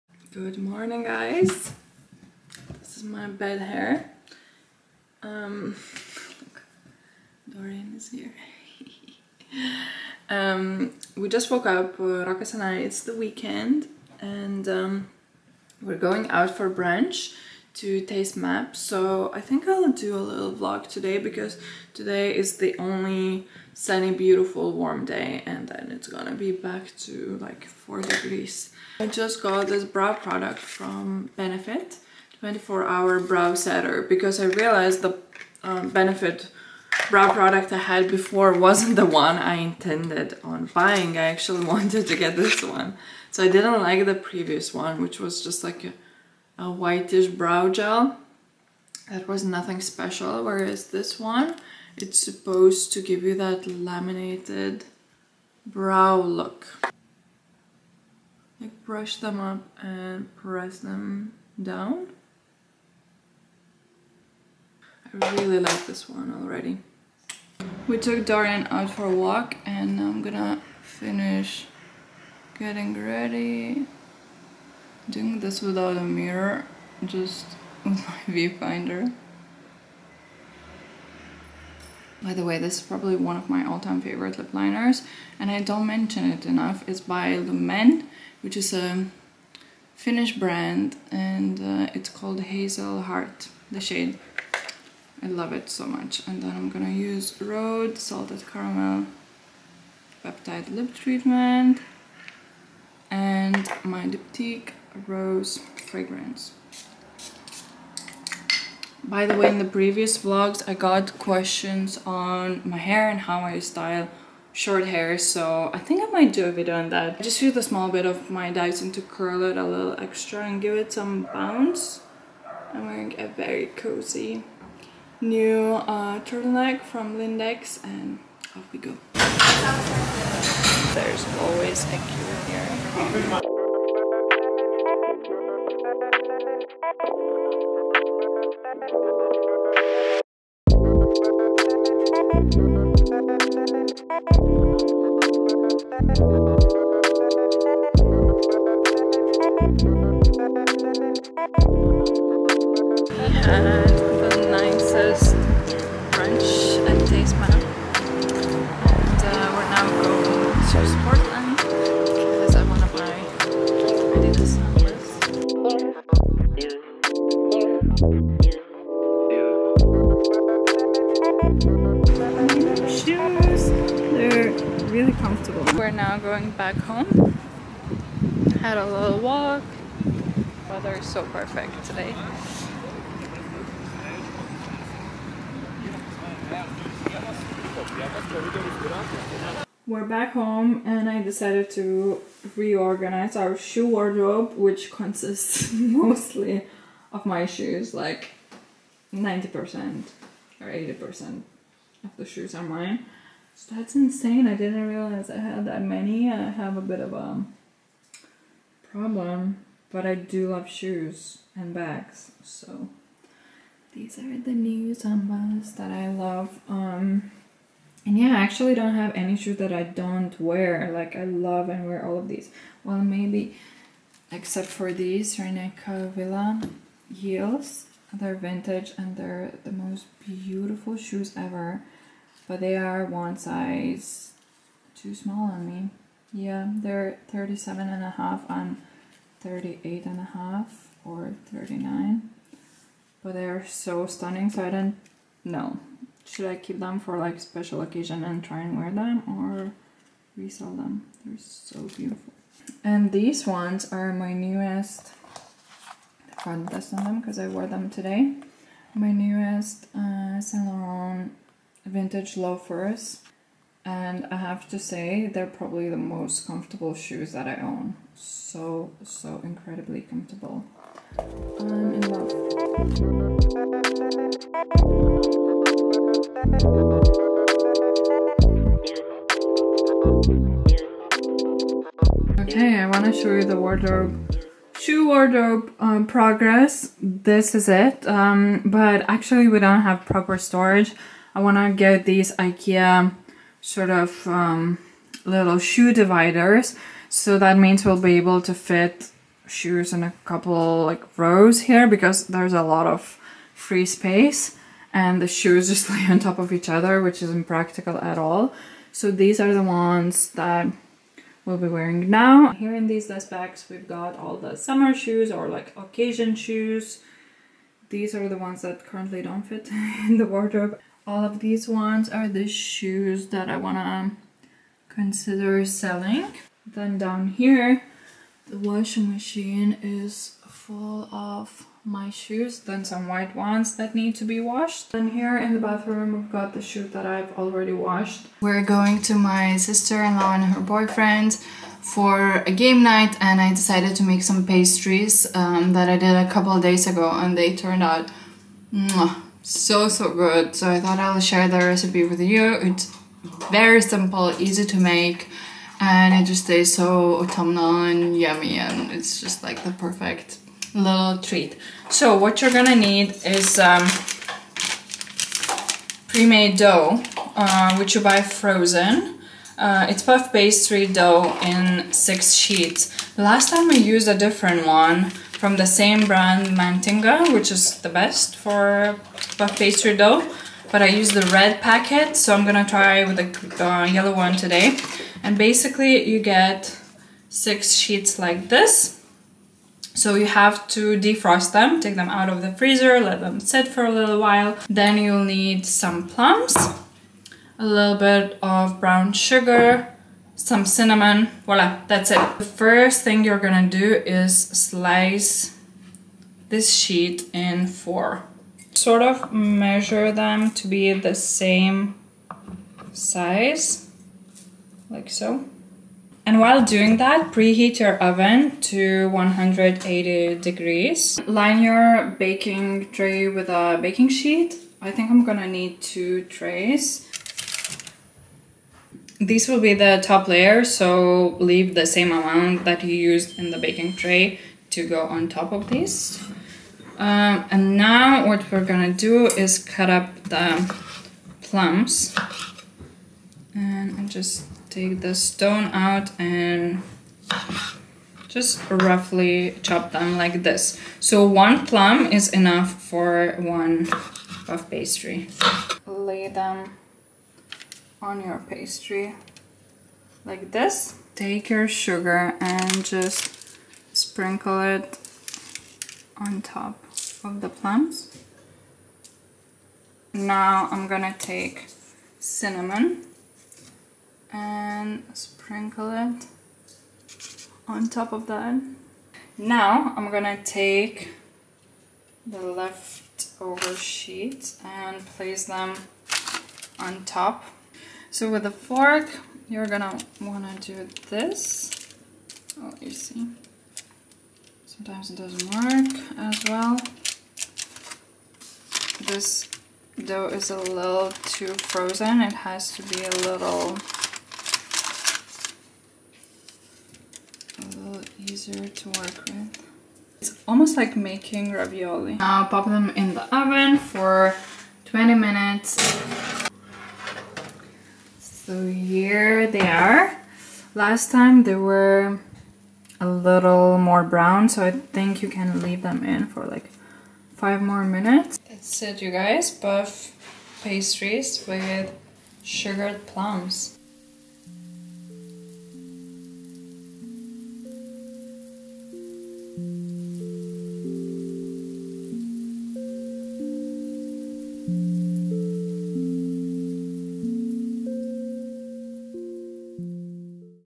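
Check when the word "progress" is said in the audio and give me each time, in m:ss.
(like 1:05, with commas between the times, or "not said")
4:46.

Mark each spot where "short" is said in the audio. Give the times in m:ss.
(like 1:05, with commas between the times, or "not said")
1:54.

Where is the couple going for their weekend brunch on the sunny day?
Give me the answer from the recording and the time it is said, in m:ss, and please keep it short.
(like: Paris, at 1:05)
Taste Map, at 0:17.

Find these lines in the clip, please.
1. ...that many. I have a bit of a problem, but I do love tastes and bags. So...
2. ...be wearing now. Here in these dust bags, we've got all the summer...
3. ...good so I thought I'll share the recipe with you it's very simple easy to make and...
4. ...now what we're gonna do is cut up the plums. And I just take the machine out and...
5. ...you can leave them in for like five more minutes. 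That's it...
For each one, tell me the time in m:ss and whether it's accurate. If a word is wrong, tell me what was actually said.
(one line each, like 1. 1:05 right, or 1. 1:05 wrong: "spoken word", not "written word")
1. 3:25 wrong: "shoes", not "tastes"
2. 5:11 right
3. 5:50 right
4. 7:17 wrong: "stone", not "machine"
5. 8:45 right.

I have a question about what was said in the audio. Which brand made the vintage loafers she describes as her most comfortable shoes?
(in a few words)
Saint Laurent.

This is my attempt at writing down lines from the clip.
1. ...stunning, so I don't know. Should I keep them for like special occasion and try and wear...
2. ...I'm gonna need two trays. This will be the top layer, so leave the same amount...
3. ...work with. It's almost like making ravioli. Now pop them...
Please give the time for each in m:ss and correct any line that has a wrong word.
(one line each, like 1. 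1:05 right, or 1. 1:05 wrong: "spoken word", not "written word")
1. 4:04 right
2. 7:05 right
3. 8:28 right.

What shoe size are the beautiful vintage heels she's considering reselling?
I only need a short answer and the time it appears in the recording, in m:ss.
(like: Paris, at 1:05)
37 and a half, at 3:57.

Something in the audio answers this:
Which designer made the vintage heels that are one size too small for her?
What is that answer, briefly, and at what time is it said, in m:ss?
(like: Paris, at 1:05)
René Caovilla, at 3:45.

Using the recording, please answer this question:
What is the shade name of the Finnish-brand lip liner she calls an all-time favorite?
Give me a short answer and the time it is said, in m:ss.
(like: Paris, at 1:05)
Hazel Heart, at 1:32.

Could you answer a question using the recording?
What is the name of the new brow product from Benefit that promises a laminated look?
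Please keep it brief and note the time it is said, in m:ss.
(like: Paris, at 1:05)
24 hour brow setter, at 0:32.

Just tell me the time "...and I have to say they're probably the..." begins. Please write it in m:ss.
4:23.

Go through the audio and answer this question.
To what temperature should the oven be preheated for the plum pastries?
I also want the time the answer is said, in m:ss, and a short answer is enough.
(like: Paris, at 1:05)
180 degrees, at 6:59.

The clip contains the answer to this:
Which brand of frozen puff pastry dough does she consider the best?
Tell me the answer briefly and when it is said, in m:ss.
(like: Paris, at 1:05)
Mantinga, at 6:16.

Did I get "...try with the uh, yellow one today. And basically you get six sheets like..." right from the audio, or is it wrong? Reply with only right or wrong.
right.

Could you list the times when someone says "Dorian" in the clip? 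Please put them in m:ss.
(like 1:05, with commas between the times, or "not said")
0:07, 1:08.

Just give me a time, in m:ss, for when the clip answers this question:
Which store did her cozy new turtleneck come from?
2:07.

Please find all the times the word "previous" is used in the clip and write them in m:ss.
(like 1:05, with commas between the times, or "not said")
0:44, 1:49.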